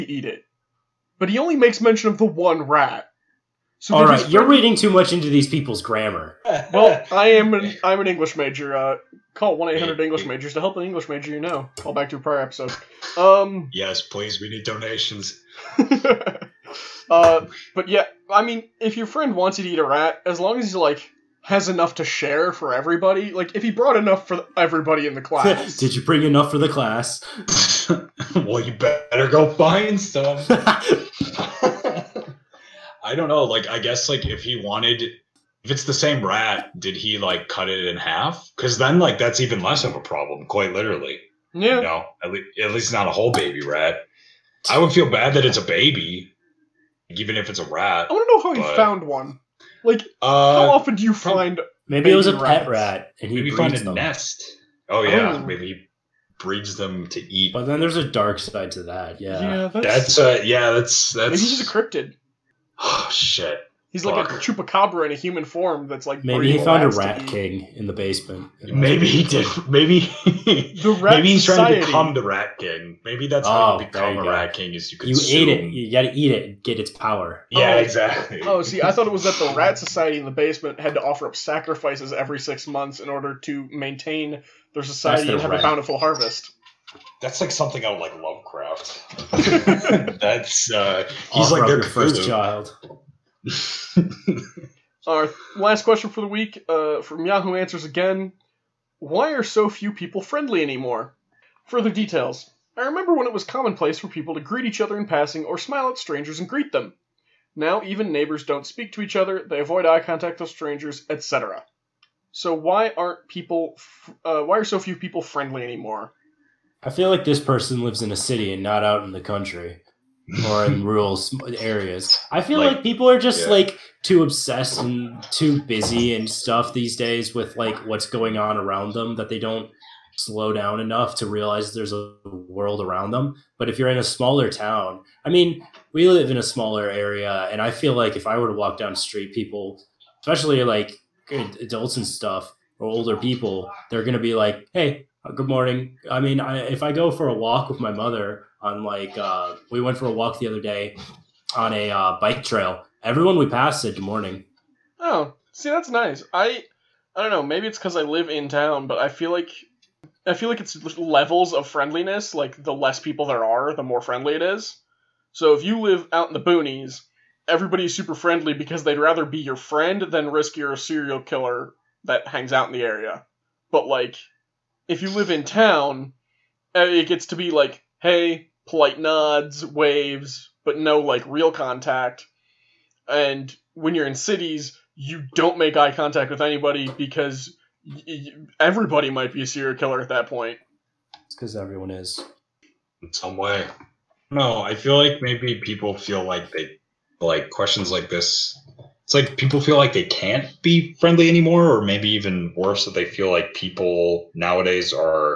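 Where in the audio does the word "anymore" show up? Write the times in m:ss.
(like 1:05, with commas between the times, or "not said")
1:40, 1:55, 3:21.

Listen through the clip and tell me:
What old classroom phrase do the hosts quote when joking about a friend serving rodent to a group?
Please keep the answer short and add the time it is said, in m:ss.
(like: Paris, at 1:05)
Did you bring enough for the class?, at 0:25.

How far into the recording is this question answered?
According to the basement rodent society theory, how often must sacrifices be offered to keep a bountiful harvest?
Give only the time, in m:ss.
1:22.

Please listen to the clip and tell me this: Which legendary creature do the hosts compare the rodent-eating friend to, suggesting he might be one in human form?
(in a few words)
Chupacabra.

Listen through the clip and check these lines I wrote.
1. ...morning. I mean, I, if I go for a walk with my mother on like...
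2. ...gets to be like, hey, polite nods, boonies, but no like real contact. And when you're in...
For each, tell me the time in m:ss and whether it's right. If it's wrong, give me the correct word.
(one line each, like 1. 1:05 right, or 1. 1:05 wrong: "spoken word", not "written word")
1. 2:25 right
2. 2:57 wrong: "waves", not "boonies".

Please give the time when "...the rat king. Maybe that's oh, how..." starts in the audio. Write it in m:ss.
1:12.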